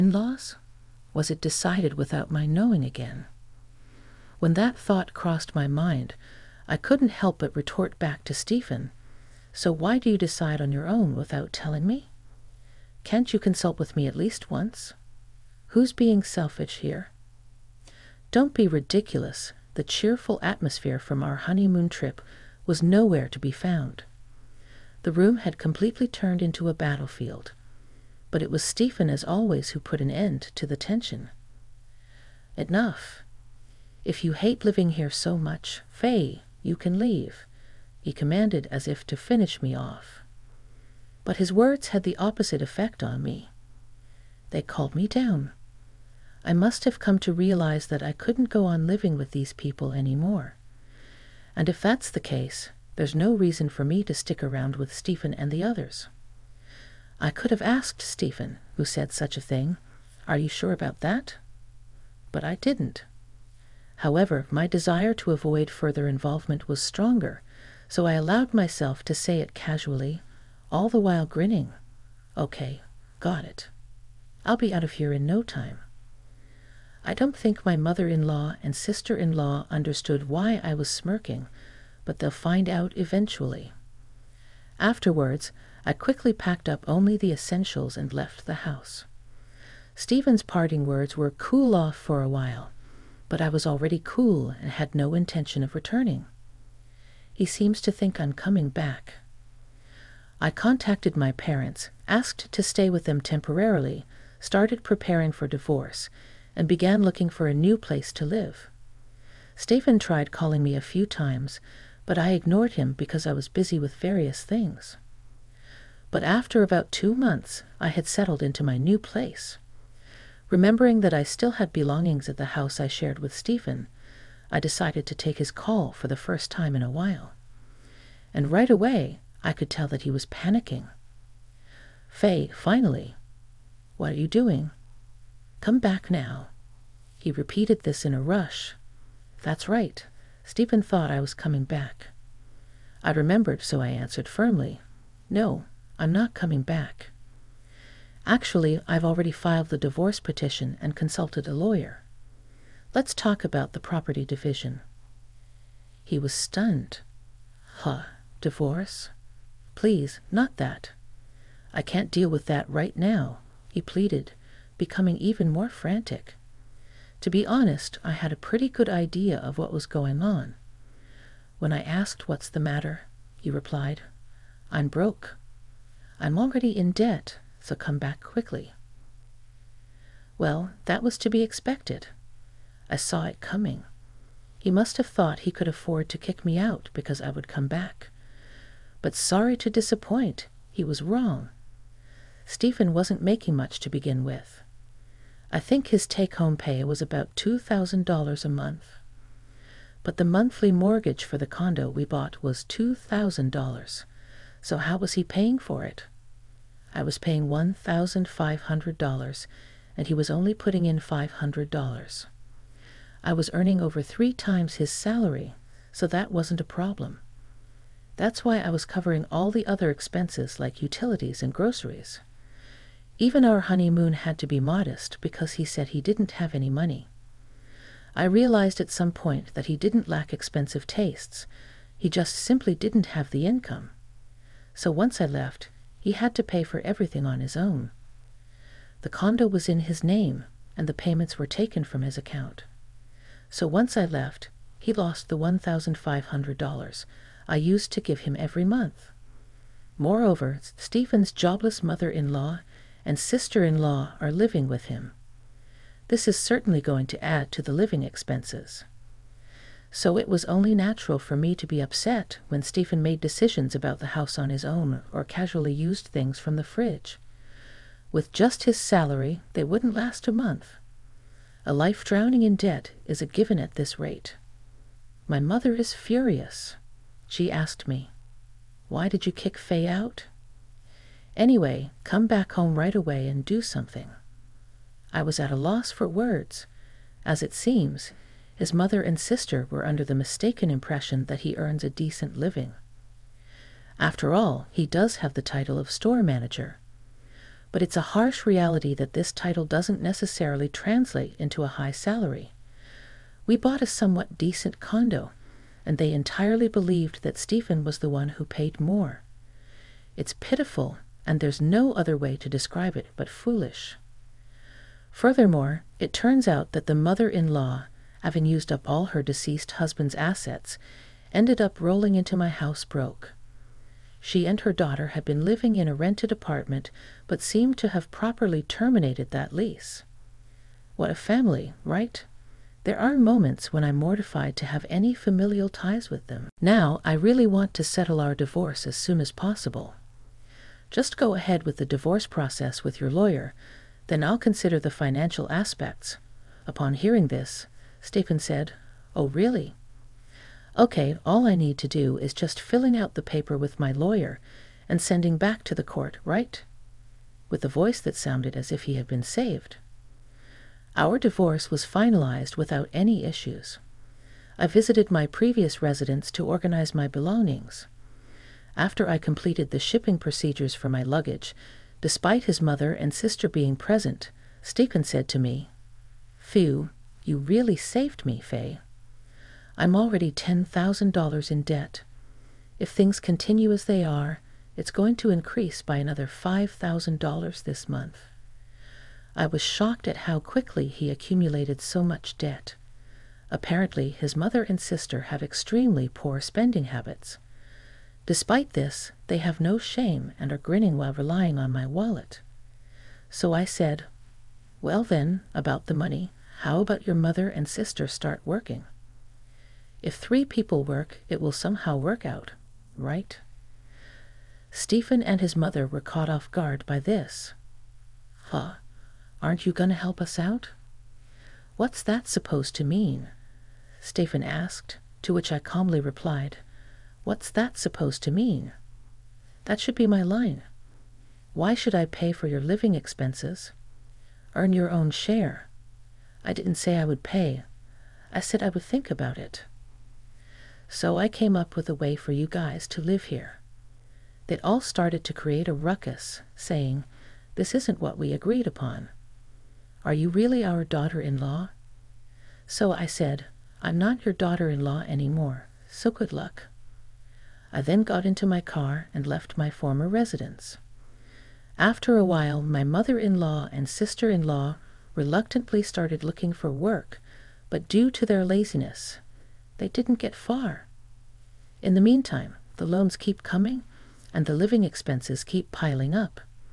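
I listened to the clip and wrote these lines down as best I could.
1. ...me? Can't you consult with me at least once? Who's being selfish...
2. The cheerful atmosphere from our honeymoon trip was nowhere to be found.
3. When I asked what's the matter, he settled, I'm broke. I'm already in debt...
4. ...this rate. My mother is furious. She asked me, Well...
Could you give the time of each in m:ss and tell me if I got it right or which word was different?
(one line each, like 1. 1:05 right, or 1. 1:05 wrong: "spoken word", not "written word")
1. 0:11 right
2. 0:19 right
3. 2:51 wrong: "replied", not "settled"
4. 4:33 wrong: "Why", not "Well".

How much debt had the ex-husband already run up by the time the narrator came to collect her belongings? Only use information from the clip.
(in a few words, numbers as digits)
$10,000.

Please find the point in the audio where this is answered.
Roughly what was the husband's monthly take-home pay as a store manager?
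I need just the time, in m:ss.
3:17.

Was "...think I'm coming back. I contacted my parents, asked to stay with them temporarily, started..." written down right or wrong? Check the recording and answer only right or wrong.
right.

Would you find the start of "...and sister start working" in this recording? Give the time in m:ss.
6:47.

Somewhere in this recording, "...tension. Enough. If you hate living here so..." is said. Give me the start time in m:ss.
0:30.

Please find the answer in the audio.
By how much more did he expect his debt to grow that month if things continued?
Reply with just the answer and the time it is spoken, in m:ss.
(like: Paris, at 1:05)
$5,000, at 6:26.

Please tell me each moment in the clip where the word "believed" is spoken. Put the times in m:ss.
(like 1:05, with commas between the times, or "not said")
5:06.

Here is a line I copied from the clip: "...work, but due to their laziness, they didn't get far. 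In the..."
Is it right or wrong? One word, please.
right.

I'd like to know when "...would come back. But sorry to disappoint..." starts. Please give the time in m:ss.
3:07.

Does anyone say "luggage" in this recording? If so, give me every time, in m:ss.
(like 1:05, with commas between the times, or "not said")
6:11.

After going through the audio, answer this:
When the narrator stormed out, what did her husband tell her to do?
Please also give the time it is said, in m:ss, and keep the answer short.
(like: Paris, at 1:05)
Cool off for a while, at 1:31.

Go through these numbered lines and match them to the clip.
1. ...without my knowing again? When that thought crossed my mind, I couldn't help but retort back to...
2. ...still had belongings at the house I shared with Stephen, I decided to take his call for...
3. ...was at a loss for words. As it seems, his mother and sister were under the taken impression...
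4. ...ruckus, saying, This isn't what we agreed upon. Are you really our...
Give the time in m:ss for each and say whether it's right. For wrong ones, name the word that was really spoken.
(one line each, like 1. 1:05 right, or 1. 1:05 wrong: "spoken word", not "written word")
1. 0:01 right
2. 2:01 right
3. 4:45 wrong: "mistaken", not "taken"
4. 7:25 right.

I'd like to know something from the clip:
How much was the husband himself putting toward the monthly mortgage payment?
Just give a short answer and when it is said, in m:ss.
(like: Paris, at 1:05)
$500, at 3:30.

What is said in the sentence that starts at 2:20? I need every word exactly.
Stephen thought I was coming back.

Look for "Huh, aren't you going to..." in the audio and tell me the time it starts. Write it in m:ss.
6:58.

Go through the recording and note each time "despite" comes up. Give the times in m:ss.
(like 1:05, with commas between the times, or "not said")
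6:11, 6:38.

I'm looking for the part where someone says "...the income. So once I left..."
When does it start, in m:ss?
3:53.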